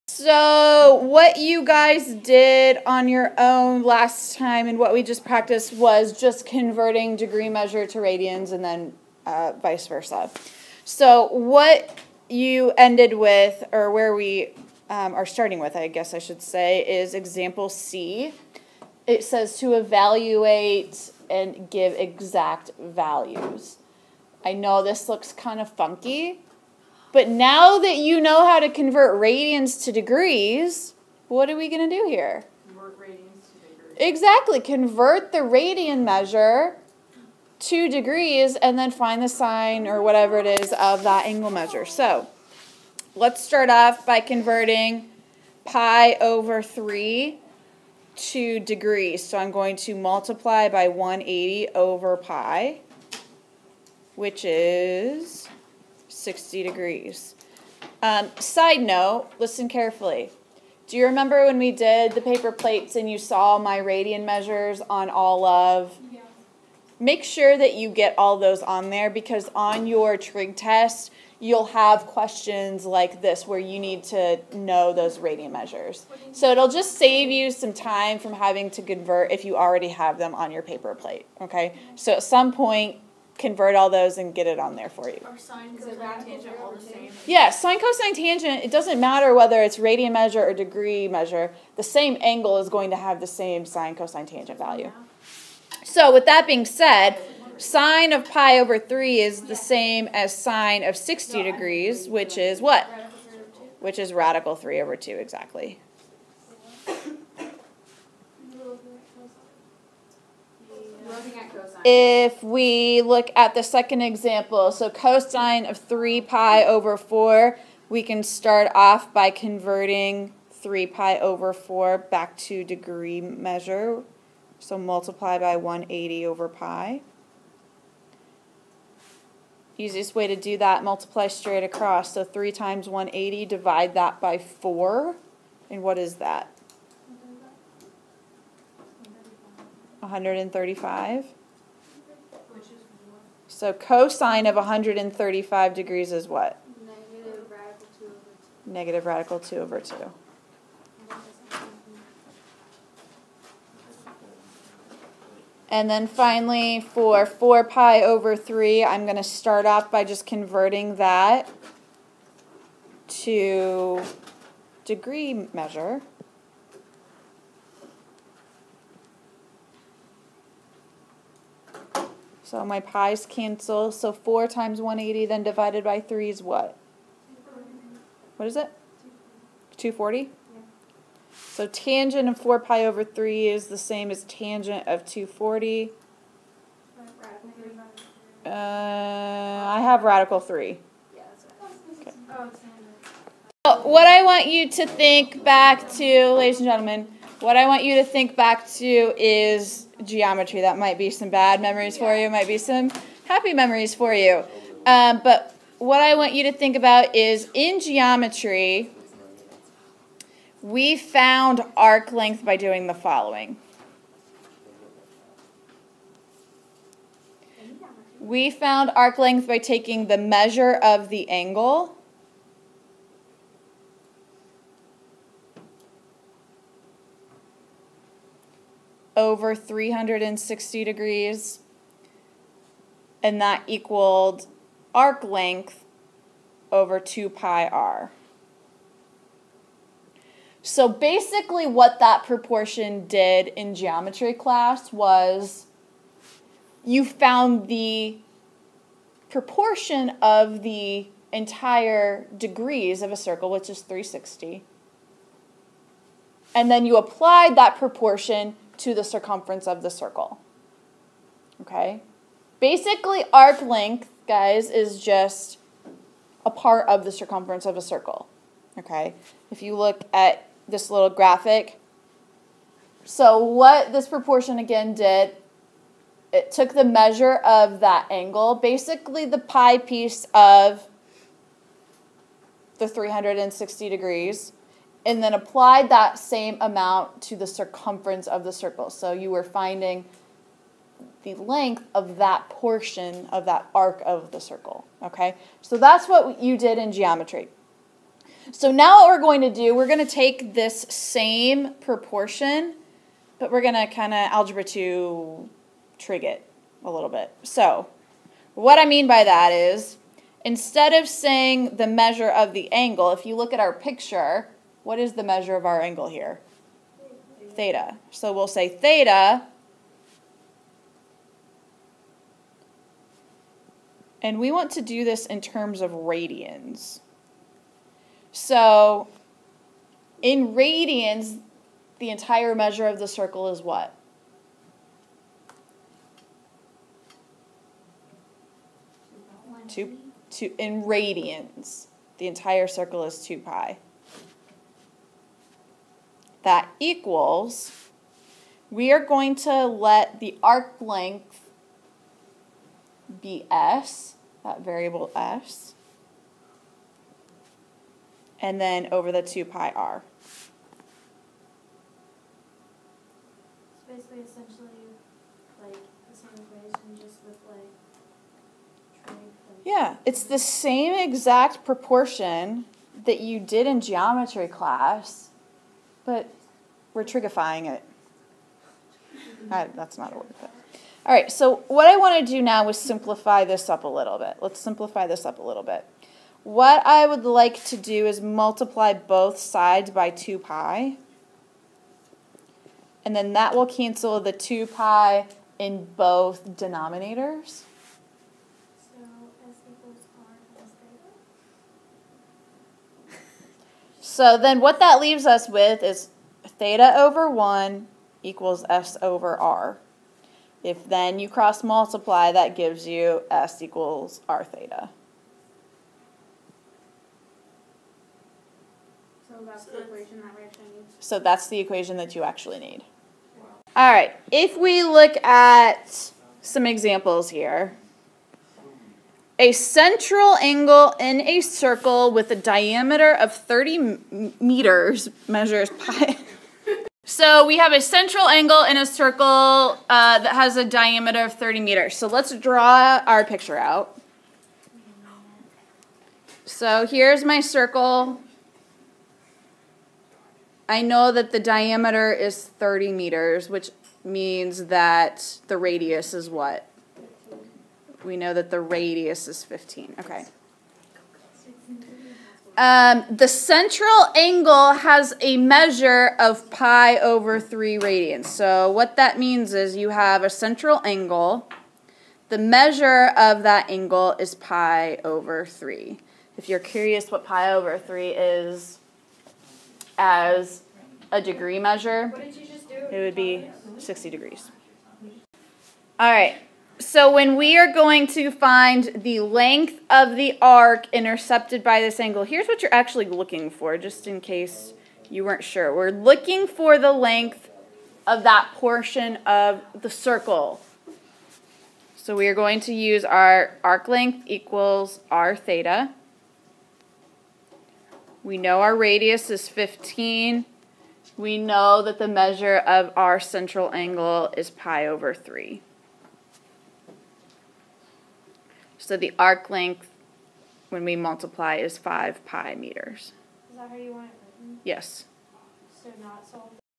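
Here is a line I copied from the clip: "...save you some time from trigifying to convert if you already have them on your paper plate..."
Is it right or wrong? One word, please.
wrong.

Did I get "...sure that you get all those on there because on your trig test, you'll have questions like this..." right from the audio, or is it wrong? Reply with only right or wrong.
right.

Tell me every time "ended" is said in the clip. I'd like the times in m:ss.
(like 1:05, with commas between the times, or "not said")
0:12.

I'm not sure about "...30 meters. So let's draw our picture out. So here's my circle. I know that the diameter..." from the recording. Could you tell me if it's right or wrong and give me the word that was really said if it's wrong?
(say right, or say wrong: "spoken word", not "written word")
right.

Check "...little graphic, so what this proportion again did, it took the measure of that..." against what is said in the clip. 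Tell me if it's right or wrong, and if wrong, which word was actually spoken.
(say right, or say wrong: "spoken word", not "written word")
right.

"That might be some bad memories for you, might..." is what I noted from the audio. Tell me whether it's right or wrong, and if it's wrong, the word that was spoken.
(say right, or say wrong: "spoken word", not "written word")
right.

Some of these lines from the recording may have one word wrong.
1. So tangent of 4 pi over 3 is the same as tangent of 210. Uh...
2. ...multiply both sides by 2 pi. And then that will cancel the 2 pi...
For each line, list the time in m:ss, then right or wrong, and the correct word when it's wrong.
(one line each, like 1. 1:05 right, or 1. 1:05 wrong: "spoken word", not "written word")
1. 3:01 wrong: "240", not "210"
2. 6:28 right.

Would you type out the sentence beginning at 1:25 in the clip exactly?
Or sine, cosine, tangent, all the same?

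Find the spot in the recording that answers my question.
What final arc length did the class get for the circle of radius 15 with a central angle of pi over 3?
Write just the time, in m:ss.
8:41.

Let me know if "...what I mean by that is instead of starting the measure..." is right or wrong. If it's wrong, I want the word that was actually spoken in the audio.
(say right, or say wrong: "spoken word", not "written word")
wrong: "saying", not "starting".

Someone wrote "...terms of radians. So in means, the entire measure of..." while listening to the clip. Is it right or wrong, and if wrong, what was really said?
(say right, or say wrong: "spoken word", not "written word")
wrong: "radians", not "means".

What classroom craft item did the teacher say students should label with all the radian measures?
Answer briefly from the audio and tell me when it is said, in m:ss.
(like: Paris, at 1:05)
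paper plates, at 1:02.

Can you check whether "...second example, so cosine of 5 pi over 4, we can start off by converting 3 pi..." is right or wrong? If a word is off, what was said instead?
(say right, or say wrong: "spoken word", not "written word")
wrong: "3", not "5".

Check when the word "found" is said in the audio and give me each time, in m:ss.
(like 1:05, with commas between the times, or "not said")
3:30, 3:38, 4:07.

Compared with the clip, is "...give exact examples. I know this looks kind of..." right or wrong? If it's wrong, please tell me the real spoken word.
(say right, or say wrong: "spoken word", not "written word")
wrong: "values", not "examples".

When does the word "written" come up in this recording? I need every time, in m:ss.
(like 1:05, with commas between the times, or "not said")
8:44.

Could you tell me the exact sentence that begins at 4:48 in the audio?
So you were finding the length of that portion of that arc of the circle, okay?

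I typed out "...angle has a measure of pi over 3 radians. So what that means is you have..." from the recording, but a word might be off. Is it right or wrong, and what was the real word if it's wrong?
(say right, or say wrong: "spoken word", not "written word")
right.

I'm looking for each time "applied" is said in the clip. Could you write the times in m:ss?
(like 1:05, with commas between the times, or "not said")
4:16, 4:45.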